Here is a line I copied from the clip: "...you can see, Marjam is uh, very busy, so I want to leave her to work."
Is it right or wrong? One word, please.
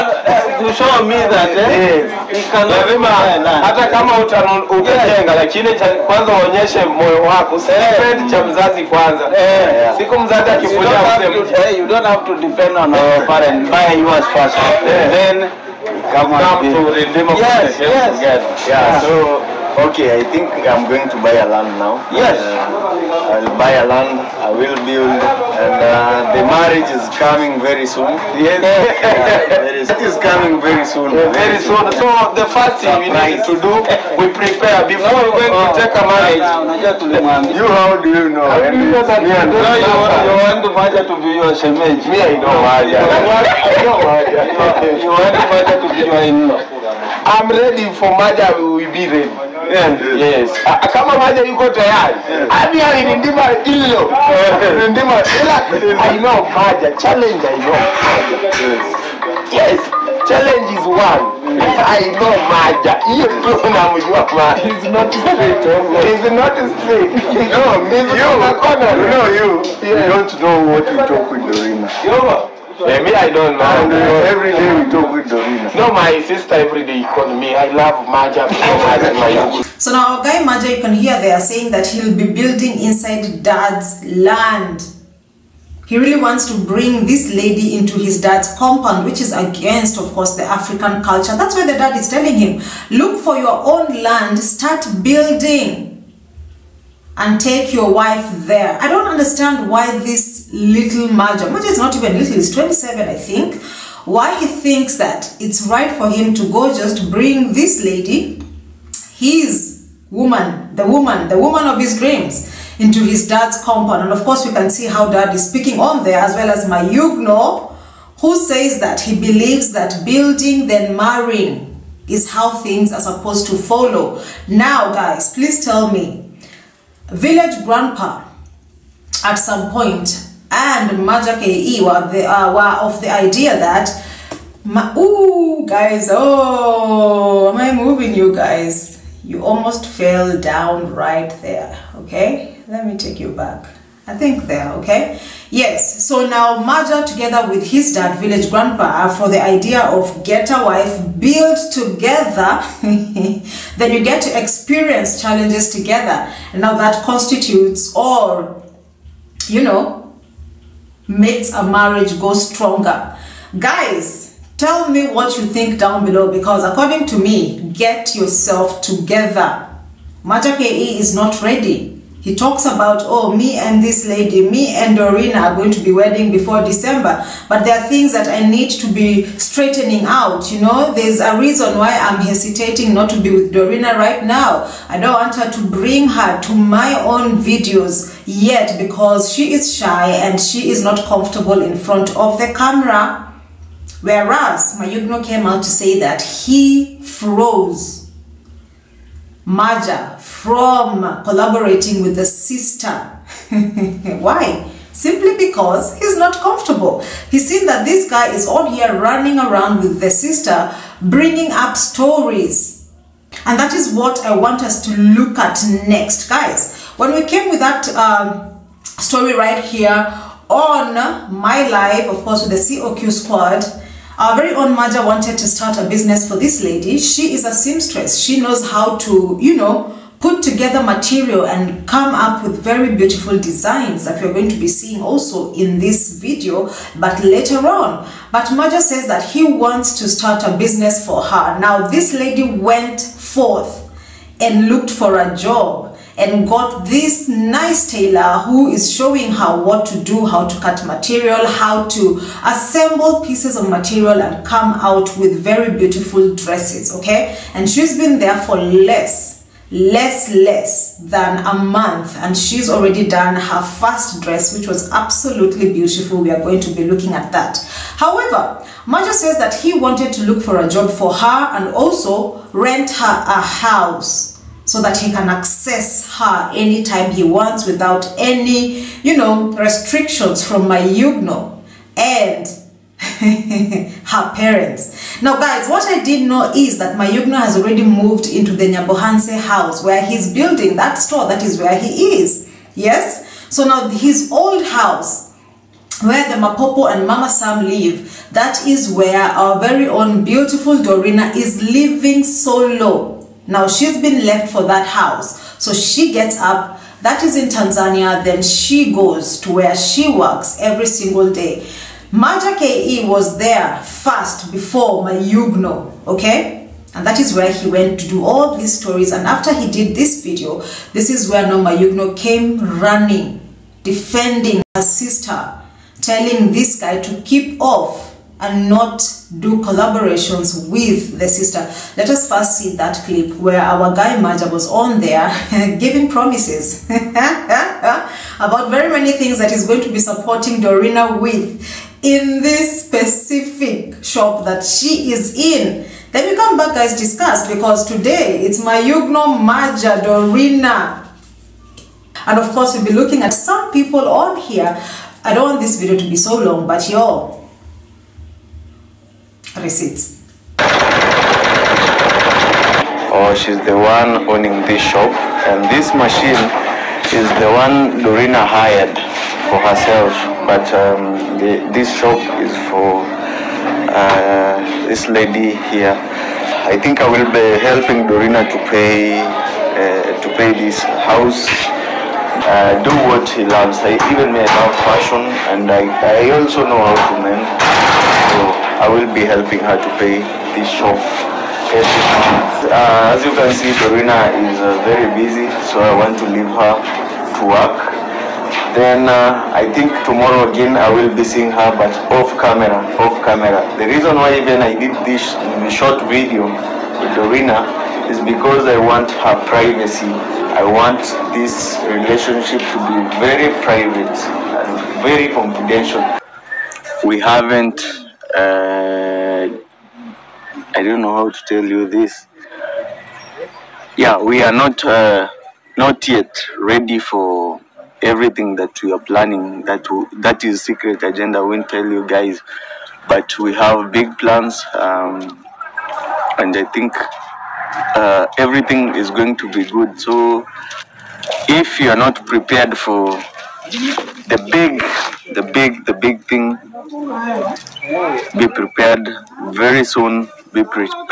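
wrong.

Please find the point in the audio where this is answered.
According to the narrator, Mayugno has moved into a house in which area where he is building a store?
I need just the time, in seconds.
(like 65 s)
288 s.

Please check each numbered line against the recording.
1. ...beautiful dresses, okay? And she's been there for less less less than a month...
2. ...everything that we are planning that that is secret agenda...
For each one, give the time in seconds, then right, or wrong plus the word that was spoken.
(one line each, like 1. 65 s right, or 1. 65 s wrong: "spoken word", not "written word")
1. 255 s right
2. 428 s right.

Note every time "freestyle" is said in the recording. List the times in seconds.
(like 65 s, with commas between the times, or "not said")
not said.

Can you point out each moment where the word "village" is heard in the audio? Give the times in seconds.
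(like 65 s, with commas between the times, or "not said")
127 s, 148 s.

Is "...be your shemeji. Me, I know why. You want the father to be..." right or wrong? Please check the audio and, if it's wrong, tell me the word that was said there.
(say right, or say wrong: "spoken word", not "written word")
right.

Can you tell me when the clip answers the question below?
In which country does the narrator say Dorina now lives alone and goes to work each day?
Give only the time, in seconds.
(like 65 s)
307 s.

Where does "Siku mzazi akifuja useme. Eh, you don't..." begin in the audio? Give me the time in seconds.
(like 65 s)
9 s.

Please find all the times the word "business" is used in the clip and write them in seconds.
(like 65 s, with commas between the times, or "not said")
225 s, 240 s.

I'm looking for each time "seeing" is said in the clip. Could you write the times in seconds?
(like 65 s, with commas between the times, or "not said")
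234 s, 401 s.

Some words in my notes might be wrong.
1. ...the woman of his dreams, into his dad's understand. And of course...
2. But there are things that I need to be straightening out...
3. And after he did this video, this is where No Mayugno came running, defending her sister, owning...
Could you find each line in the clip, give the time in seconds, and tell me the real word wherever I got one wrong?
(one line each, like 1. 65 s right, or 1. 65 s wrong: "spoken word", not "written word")
1. 111 s wrong: "compound", not "understand"
2. 177 s right
3. 319 s wrong: "telling", not "owning".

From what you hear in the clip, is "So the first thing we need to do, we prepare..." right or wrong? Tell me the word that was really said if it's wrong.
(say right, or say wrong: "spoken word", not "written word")
right.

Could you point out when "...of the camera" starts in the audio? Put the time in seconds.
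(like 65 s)
192 s.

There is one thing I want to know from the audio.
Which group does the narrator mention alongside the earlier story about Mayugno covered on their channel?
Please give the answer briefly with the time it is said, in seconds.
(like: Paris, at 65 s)
COQ squad, at 222 s.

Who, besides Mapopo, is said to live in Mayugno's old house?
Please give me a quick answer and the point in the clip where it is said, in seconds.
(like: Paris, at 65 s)
Mama Sam, at 297 s.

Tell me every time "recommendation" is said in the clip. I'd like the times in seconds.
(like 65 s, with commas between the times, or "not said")
not said.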